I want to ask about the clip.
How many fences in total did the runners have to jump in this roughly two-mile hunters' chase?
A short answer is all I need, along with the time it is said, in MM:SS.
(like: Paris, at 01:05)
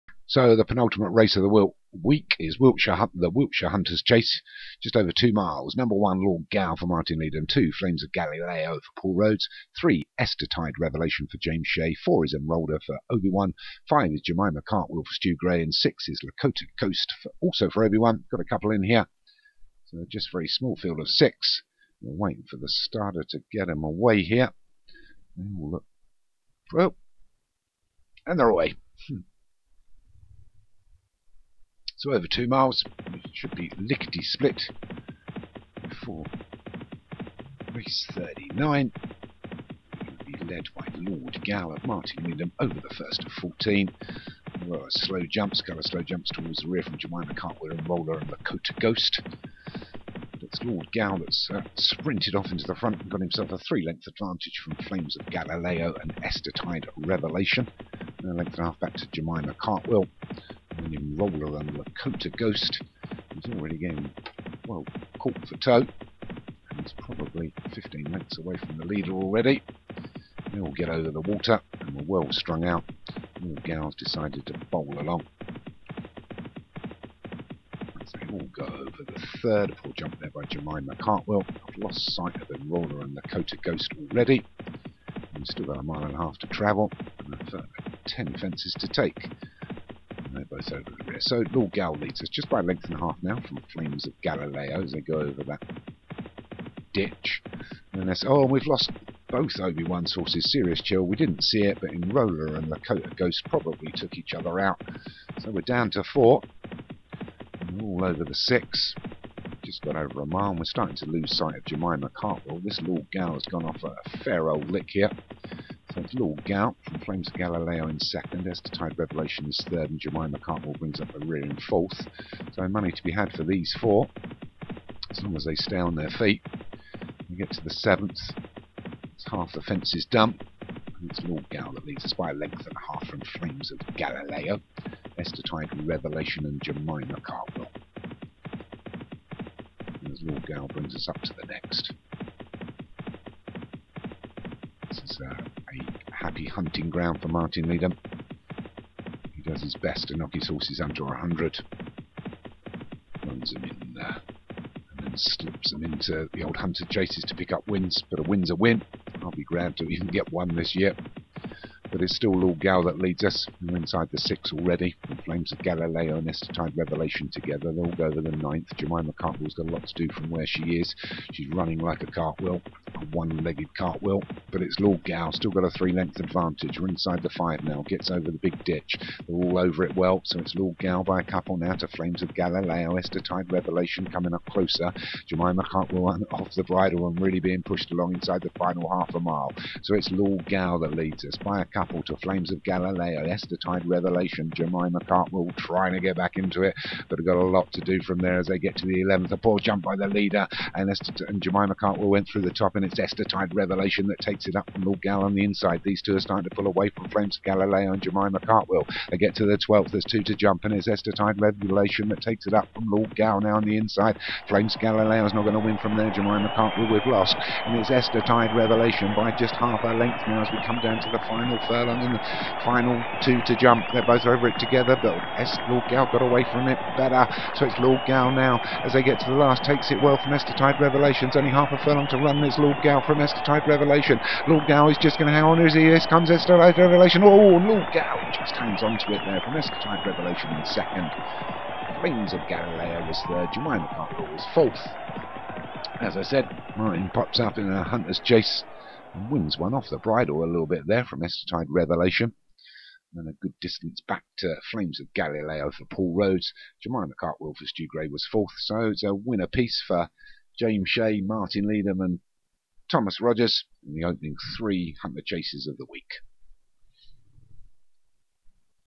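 14, at 00:43.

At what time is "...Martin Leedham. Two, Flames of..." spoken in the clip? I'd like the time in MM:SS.
00:06.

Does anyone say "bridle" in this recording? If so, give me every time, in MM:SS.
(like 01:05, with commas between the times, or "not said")
03:06, 04:09.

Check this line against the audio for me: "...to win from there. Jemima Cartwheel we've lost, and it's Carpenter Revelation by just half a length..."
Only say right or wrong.
wrong.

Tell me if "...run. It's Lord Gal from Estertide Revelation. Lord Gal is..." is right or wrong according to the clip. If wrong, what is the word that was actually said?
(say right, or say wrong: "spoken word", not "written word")
right.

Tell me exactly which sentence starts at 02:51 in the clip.
She's running like a cartwheel, a one-legged cartwheel, but it's Lord Gal.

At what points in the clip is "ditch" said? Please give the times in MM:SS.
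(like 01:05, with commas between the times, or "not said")
01:36, 02:58.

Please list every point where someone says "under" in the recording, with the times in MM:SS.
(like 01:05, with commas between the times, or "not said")
02:30.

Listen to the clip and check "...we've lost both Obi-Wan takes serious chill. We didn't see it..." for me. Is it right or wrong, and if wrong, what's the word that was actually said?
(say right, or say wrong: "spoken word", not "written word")
wrong: "sources", not "takes".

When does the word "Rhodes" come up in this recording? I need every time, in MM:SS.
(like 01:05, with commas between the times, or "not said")
00:09, 04:16.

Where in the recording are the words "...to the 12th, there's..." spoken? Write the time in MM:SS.
03:29.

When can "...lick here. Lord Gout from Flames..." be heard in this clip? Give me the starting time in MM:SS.
01:54.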